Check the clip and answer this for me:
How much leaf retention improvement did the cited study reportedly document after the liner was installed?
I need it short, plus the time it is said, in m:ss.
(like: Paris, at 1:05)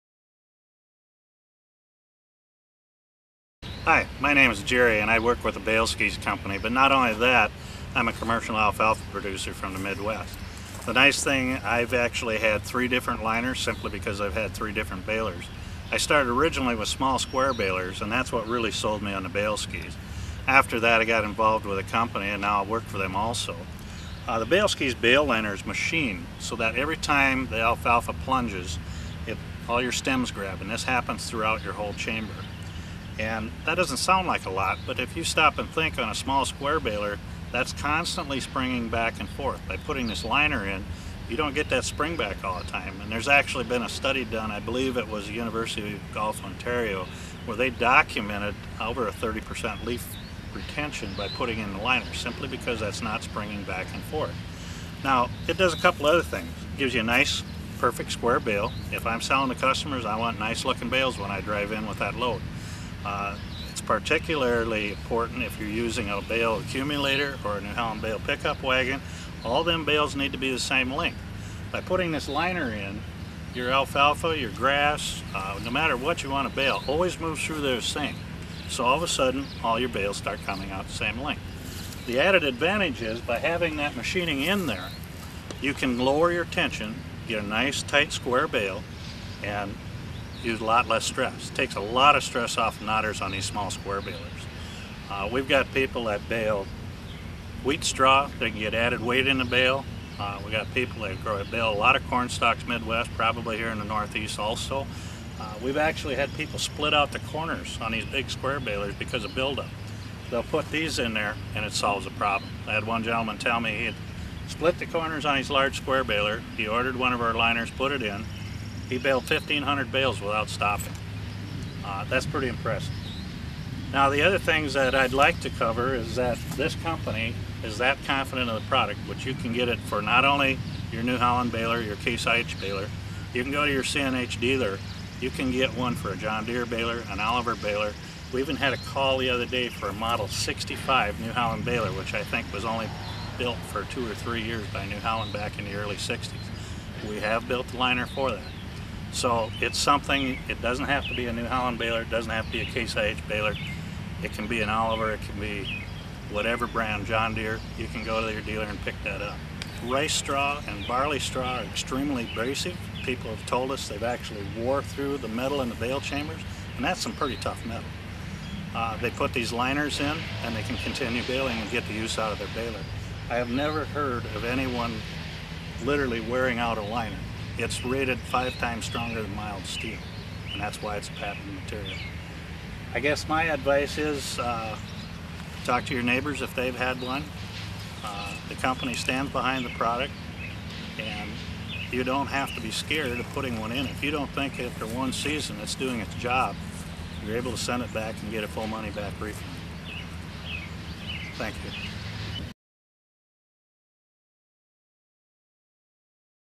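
over 30%, at 0:48.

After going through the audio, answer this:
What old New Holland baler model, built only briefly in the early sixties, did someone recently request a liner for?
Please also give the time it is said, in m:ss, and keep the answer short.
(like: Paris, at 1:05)
Model 65, at 2:19.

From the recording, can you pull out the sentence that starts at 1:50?
They'll put these in there and it solves the problem.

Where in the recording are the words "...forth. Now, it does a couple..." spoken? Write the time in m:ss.
0:54.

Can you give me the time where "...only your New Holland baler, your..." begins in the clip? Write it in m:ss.
2:10.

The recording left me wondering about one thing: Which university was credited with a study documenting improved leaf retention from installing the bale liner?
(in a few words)
University of Guelph.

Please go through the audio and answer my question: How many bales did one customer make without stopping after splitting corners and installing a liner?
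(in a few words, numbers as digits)
1,500.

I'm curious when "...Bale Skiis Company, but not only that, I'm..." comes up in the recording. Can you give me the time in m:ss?
0:05.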